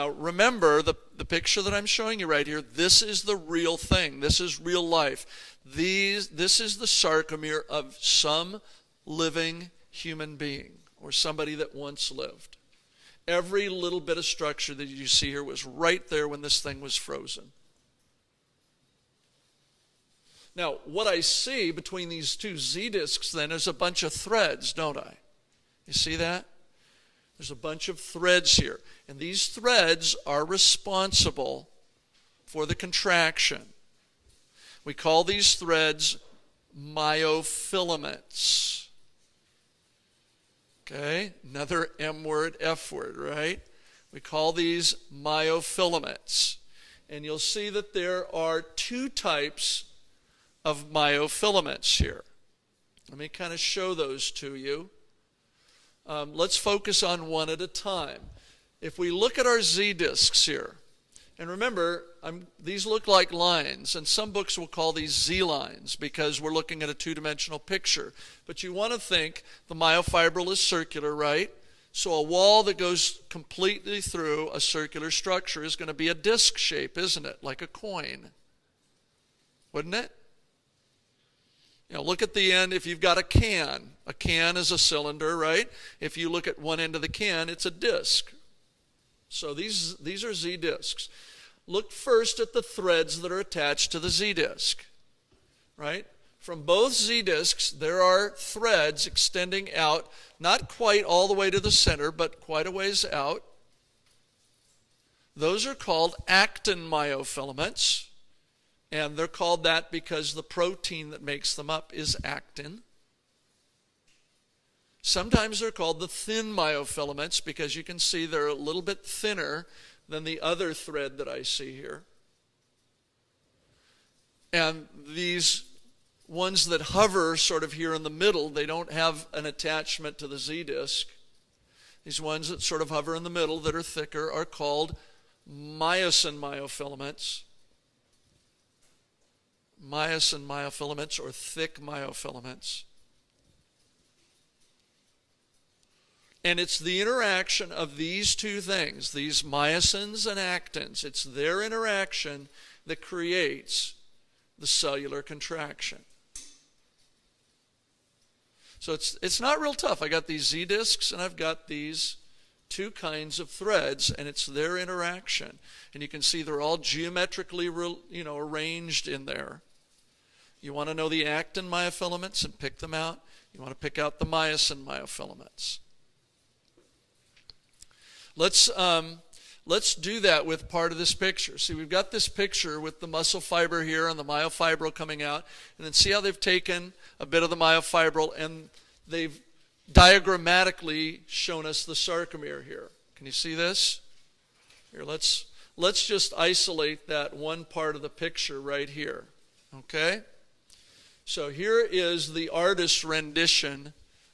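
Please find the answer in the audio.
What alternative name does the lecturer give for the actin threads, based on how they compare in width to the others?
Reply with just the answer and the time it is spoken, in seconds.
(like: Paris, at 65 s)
thin myofilaments, at 116 s.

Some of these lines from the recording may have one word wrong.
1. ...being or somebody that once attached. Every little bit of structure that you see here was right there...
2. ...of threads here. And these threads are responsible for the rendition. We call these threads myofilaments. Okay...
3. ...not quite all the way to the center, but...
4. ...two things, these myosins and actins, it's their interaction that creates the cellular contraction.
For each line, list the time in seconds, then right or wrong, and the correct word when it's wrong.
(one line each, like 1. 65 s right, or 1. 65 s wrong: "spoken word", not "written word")
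1. 10 s wrong: "lived", not "attached"
2. 27 s wrong: "contraction", not "rendition"
3. 100 s right
4. 148 s right.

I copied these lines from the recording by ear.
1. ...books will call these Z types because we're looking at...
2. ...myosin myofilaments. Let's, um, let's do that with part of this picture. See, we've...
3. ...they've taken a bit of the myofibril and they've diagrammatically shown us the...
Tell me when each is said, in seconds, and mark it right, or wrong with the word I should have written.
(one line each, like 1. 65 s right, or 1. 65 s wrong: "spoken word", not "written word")
1. 64 s wrong: "lines", not "types"
2. 174 s right
3. 186 s right.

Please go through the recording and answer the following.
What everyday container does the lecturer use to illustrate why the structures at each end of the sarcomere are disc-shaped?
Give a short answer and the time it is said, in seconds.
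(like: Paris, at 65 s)
A can, at 82 s.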